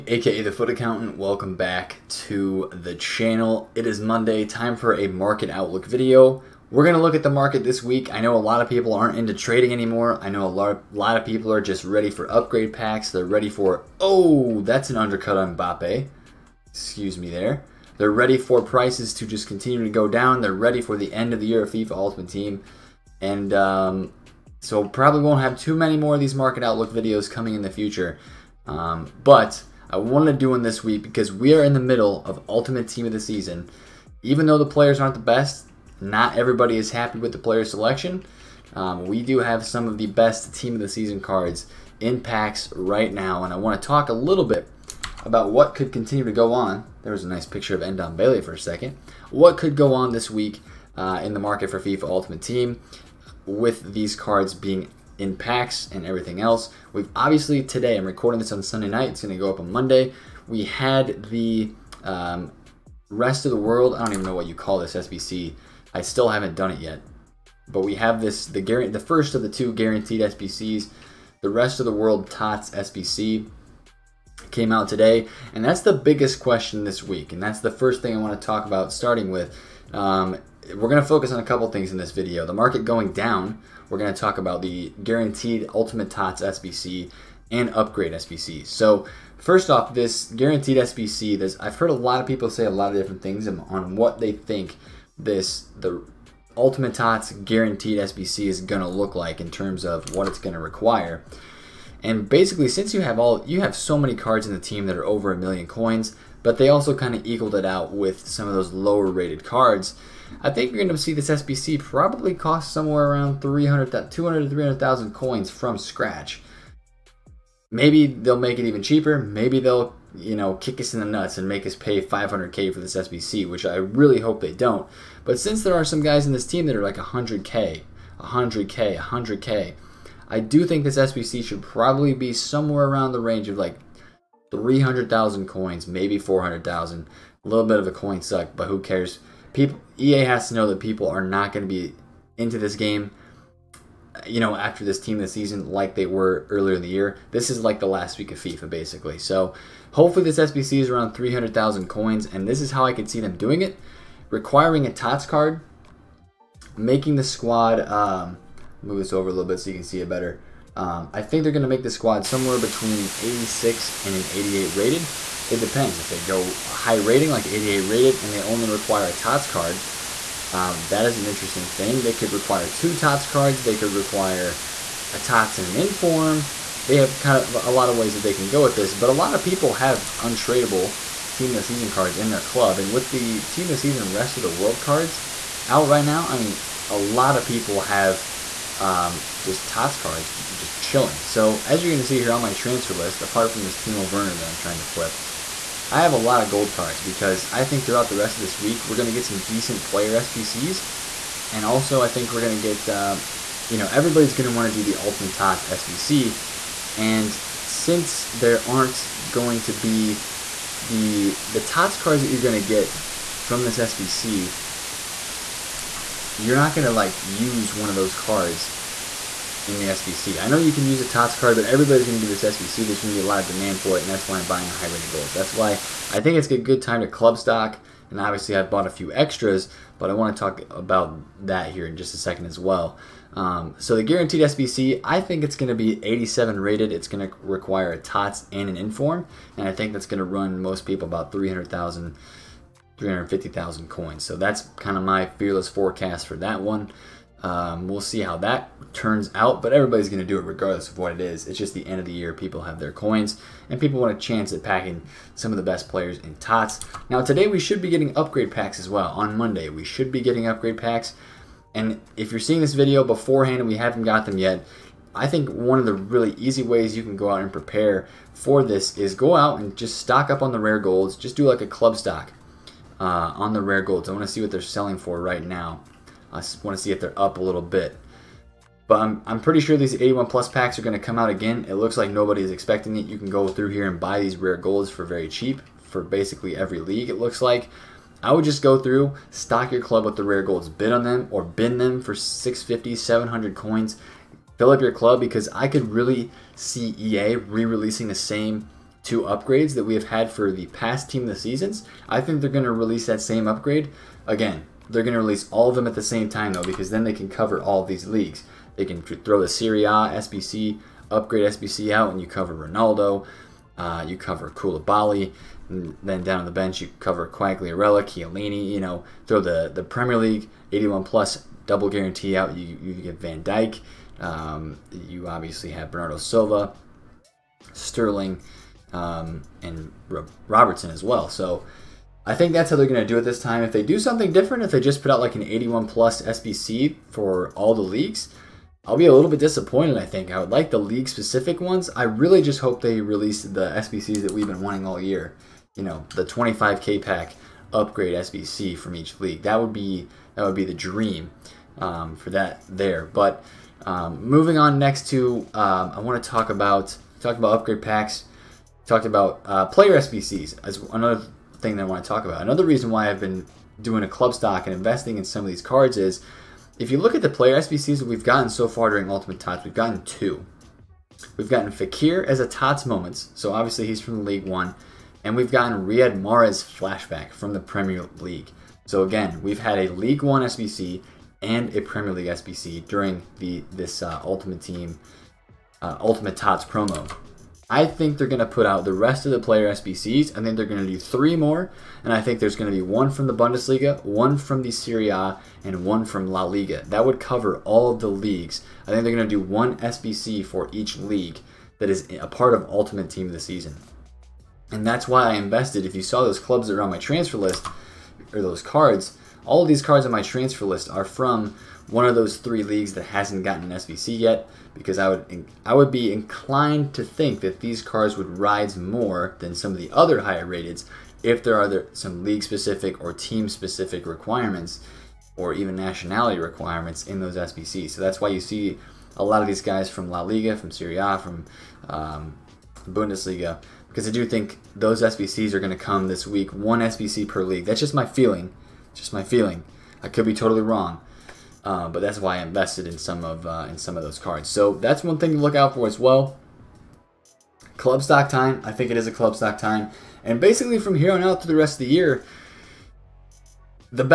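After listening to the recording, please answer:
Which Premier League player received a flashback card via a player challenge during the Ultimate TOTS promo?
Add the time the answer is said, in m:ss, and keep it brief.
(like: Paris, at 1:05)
Riyad Mahrez, at 6:15.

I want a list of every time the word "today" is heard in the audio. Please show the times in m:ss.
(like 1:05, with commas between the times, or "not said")
0:57, 1:14, 4:17.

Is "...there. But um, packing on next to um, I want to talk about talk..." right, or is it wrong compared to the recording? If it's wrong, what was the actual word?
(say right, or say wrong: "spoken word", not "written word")
wrong: "moving", not "packing".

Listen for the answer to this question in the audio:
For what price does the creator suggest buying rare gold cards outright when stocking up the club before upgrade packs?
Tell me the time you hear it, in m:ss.
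4:52.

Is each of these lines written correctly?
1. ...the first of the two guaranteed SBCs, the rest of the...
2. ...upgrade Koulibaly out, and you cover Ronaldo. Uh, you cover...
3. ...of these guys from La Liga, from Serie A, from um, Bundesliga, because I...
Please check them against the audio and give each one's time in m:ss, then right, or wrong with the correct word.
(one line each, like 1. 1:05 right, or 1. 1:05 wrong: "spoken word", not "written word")
1. 1:08 right
2. 5:11 wrong: "SBC", not "Koulibaly"
3. 7:09 right.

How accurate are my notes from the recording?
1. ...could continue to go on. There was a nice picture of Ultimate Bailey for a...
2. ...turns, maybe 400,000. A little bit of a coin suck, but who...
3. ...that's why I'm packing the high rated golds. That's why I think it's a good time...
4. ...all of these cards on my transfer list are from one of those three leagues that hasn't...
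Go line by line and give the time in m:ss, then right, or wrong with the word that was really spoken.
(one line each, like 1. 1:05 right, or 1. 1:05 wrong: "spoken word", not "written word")
1. 0:45 wrong: "Endon", not "Ultimate"
2. 2:15 wrong: "coins", not "turns"
3. 3:44 wrong: "buying", not "packing"
4. 6:49 right.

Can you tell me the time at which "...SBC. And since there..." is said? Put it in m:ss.
3:25.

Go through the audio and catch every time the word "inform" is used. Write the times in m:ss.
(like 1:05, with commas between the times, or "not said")
2:55, 3:58.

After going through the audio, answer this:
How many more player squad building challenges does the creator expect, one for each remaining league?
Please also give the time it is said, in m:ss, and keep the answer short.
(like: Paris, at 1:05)
3, at 6:30.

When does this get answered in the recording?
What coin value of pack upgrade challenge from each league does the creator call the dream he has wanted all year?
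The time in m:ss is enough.
5:46.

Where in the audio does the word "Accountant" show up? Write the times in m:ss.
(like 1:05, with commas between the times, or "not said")
0:00.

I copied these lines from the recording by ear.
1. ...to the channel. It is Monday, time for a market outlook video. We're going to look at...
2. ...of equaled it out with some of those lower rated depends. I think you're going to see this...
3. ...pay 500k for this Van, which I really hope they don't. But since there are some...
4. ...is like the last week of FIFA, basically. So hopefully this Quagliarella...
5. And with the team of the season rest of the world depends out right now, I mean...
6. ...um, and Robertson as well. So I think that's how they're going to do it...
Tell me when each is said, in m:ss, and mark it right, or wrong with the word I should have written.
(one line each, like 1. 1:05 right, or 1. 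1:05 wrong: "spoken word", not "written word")
1. 0:02 right
2. 1:47 wrong: "cards", not "depends"
3. 2:01 wrong: "SBC", not "Van"
4. 2:27 wrong: "SBC", not "Quagliarella"
5. 3:02 wrong: "cards", not "depends"
6. 5:28 right.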